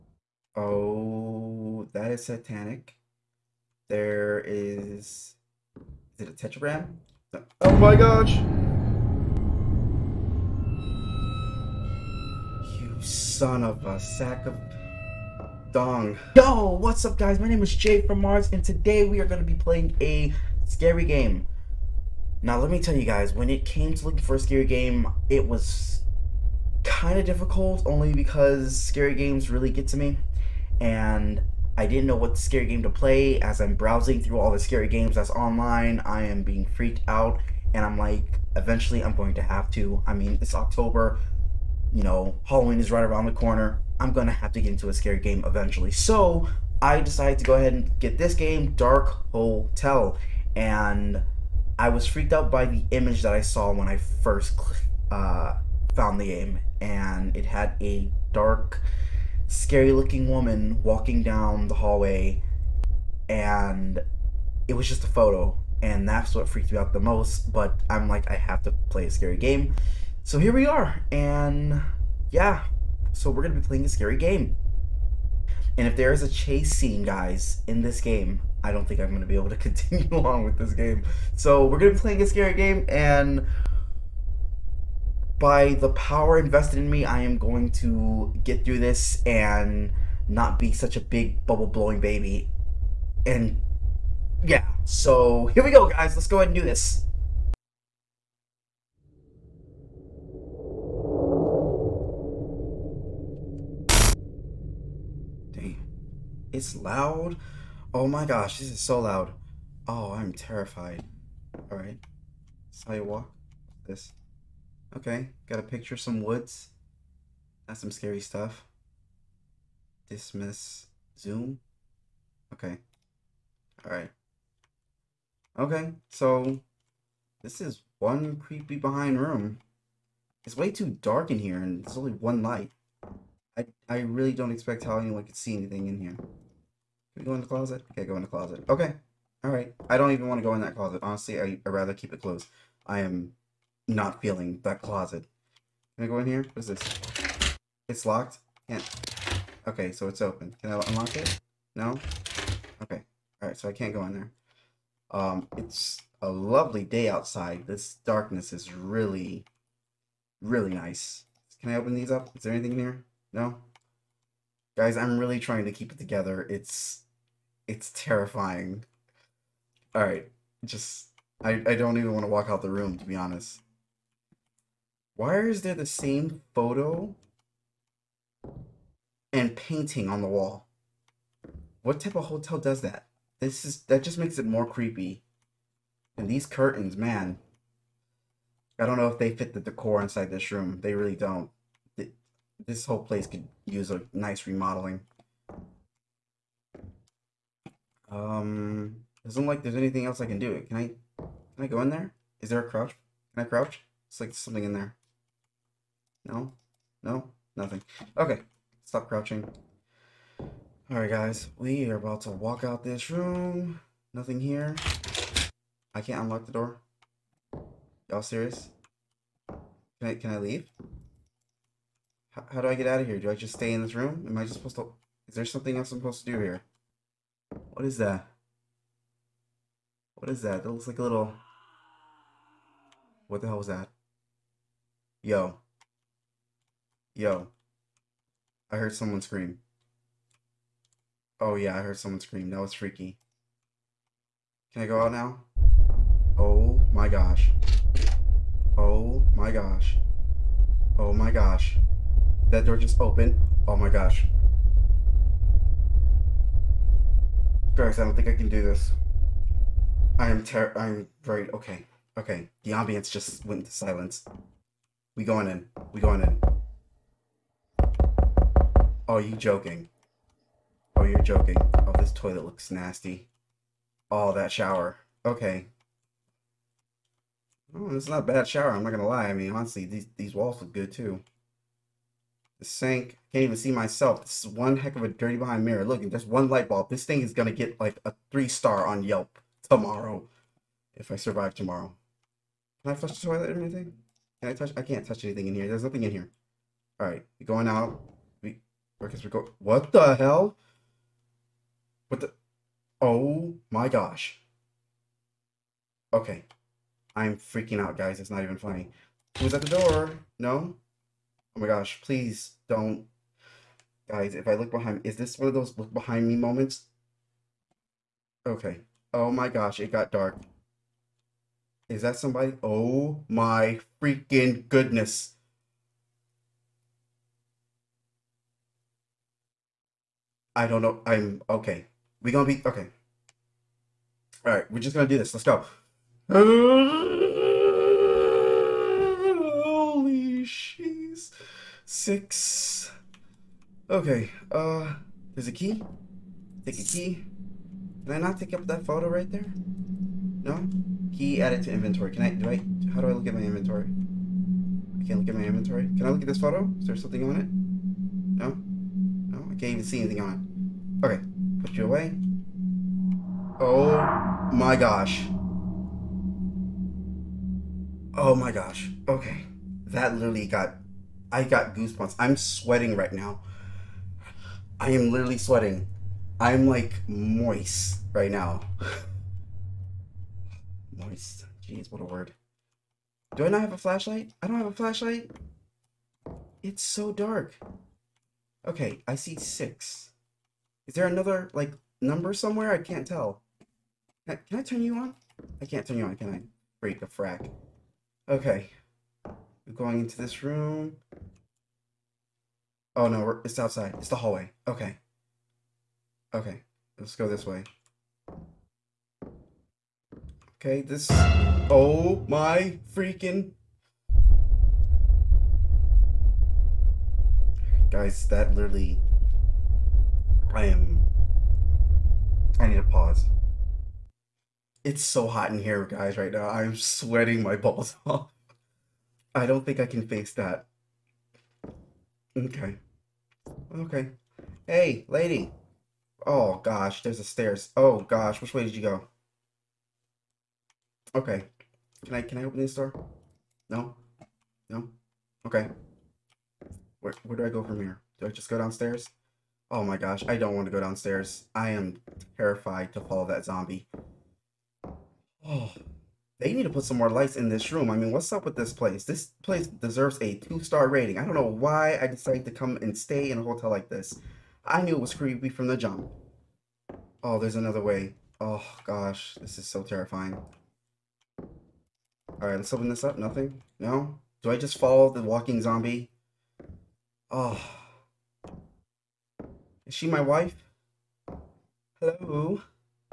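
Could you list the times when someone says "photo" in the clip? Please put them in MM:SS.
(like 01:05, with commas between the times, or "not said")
01:05, 02:56, 05:48, 05:56.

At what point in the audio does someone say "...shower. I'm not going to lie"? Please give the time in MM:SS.
04:38.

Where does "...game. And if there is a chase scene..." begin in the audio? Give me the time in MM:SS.
01:14.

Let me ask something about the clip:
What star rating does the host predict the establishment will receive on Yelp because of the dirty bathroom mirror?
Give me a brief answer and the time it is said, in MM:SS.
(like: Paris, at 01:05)
3, at 04:48.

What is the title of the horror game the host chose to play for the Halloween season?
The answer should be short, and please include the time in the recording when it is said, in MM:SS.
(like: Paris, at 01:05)
Dark Hotel, at 00:48.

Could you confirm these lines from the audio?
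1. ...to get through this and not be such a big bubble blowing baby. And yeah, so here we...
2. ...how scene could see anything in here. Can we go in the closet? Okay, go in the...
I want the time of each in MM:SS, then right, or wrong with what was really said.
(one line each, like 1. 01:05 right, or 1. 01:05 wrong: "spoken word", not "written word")
1. 01:27 right
2. 02:14 wrong: "anyone", not "scene".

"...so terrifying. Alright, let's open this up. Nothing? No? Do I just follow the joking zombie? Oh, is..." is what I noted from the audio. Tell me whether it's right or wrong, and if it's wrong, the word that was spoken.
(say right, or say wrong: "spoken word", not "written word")
wrong: "walking", not "joking".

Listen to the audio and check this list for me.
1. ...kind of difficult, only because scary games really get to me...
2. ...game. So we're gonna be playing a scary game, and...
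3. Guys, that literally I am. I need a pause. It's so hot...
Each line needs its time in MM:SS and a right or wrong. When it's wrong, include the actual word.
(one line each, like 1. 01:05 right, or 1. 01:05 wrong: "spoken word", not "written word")
1. 00:26 right
2. 01:20 right
3. 06:57 right.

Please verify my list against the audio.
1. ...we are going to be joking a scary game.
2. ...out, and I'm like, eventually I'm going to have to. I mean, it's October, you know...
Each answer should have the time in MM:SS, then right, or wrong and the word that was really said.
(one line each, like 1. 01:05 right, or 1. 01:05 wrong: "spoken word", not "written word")
1. 00:19 wrong: "playing", not "joking"
2. 00:37 right.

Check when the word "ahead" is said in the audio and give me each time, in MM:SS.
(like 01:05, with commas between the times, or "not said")
00:47, 01:36.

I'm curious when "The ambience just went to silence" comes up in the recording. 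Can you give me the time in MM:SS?
04:22.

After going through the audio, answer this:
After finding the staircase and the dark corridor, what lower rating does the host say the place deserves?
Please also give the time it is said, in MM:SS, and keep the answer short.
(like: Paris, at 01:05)
2, at 07:40.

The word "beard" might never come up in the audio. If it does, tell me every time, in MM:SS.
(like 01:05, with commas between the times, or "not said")
not said.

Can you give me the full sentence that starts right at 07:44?
I knew it was creepy from the jump.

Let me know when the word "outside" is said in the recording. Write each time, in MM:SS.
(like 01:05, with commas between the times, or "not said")
02:37, 06:43.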